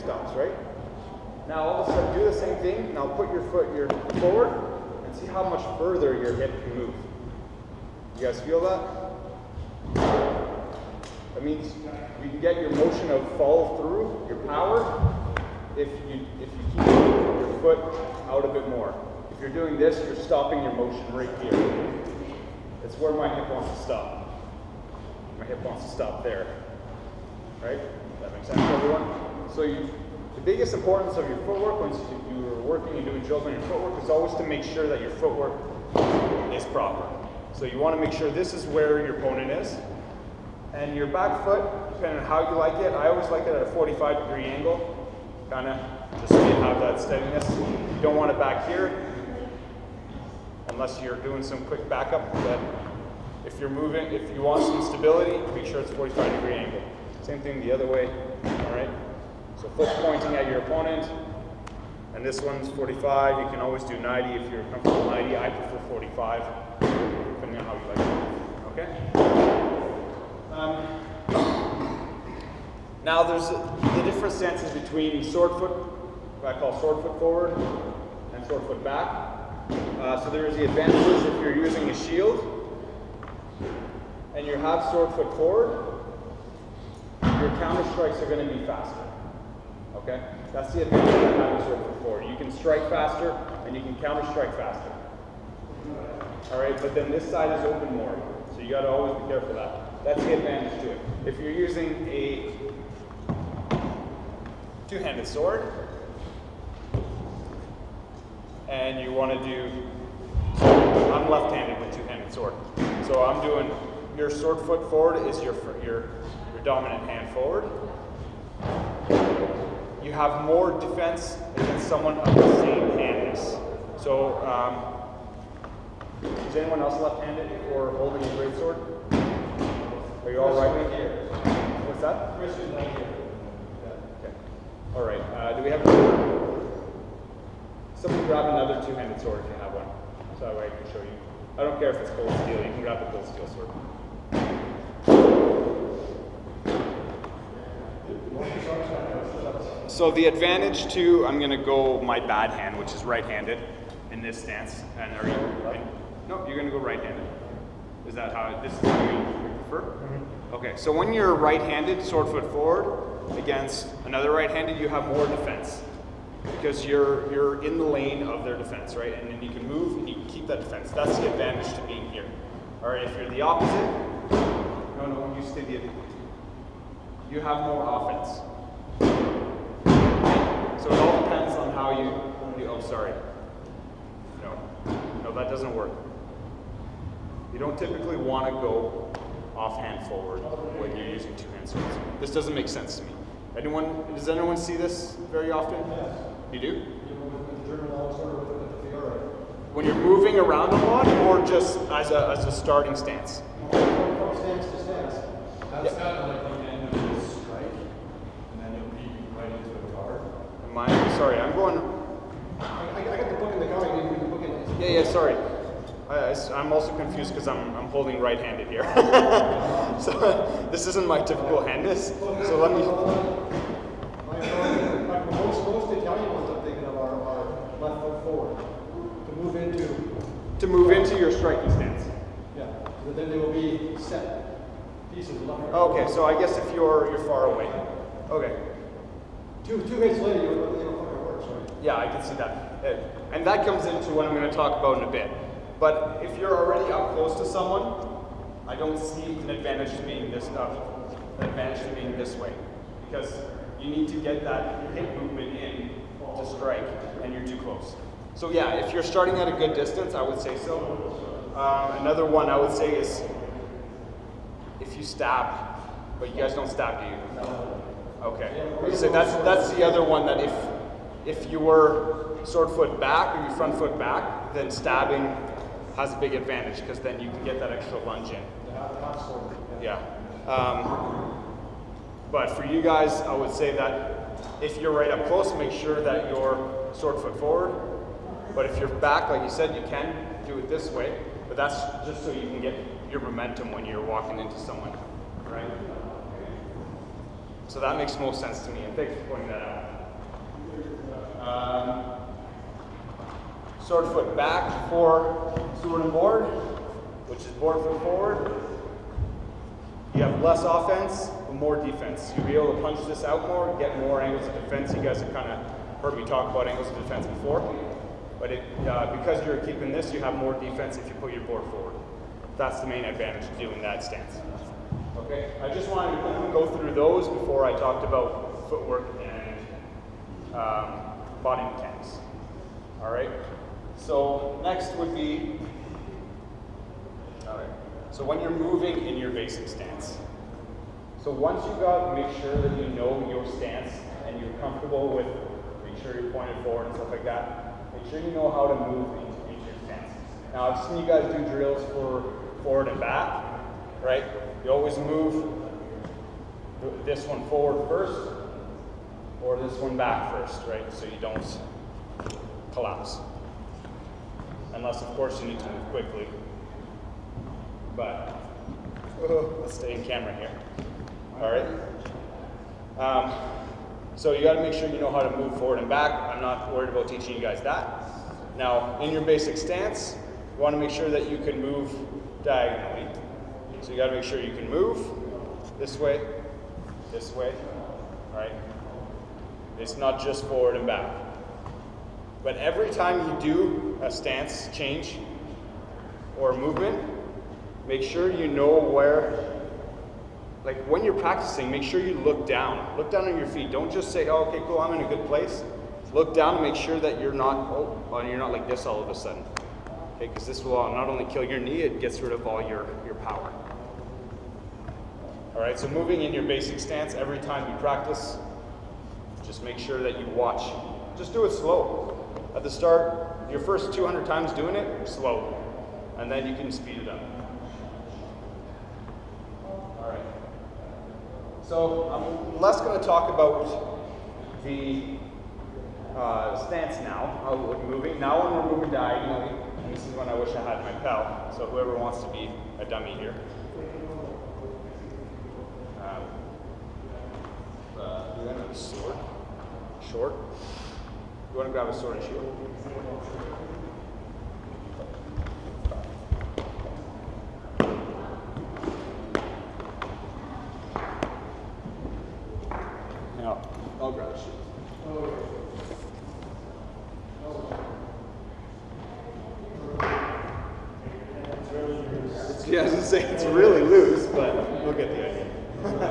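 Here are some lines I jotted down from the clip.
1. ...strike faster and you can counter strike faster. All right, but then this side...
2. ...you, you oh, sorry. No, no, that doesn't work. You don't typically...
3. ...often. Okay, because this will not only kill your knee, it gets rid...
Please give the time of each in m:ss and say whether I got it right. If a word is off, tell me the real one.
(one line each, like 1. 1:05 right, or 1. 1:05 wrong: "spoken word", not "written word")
1. 1:32 right
2. 3:01 right
3. 6:49 wrong: "sudden", not "often".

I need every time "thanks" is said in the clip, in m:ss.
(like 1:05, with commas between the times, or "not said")
4:58.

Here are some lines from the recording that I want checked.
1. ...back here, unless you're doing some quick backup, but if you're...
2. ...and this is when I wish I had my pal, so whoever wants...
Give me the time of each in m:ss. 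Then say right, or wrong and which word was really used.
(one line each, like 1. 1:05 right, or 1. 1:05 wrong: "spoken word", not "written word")
1. 0:48 right
2. 7:19 right.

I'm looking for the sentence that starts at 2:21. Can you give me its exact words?
I don't care if it's cold steel.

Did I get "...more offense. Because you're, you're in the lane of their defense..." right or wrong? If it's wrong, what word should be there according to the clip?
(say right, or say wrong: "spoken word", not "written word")
wrong: "defense", not "offense".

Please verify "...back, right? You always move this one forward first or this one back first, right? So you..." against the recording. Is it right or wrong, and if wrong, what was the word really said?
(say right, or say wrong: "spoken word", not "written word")
right.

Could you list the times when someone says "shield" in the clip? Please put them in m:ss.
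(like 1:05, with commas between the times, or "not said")
1:21, 7:32, 7:44.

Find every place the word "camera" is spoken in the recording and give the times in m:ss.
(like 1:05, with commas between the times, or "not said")
6:10.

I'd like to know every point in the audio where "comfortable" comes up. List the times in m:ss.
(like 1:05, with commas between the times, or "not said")
1:04, 5:44.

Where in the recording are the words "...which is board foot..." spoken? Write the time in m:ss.
5:07.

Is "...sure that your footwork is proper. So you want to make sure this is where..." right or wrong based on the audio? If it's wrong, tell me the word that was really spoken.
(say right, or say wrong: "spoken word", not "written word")
right.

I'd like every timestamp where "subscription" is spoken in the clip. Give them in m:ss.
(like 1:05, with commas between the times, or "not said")
not said.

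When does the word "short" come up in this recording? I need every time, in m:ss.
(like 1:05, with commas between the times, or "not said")
7:30.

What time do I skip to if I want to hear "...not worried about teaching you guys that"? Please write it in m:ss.
6:16.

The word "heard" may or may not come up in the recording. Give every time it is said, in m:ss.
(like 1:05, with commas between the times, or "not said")
5:15.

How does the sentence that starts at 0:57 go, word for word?
Same thing the other way, all right?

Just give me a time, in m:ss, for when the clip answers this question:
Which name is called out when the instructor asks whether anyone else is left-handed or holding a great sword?
2:12.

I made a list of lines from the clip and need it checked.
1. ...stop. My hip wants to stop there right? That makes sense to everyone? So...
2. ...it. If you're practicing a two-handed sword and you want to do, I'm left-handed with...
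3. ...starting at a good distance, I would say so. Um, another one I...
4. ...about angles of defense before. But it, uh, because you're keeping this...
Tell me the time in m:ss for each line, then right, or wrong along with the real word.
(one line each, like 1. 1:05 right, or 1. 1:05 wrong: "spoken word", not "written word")
1. 0:23 right
2. 1:40 wrong: "using", not "practicing"
3. 4:19 right
4. 5:16 right.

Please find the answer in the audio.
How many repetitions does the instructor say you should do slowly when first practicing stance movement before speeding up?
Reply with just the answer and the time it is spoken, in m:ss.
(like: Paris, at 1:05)
200, at 7:03.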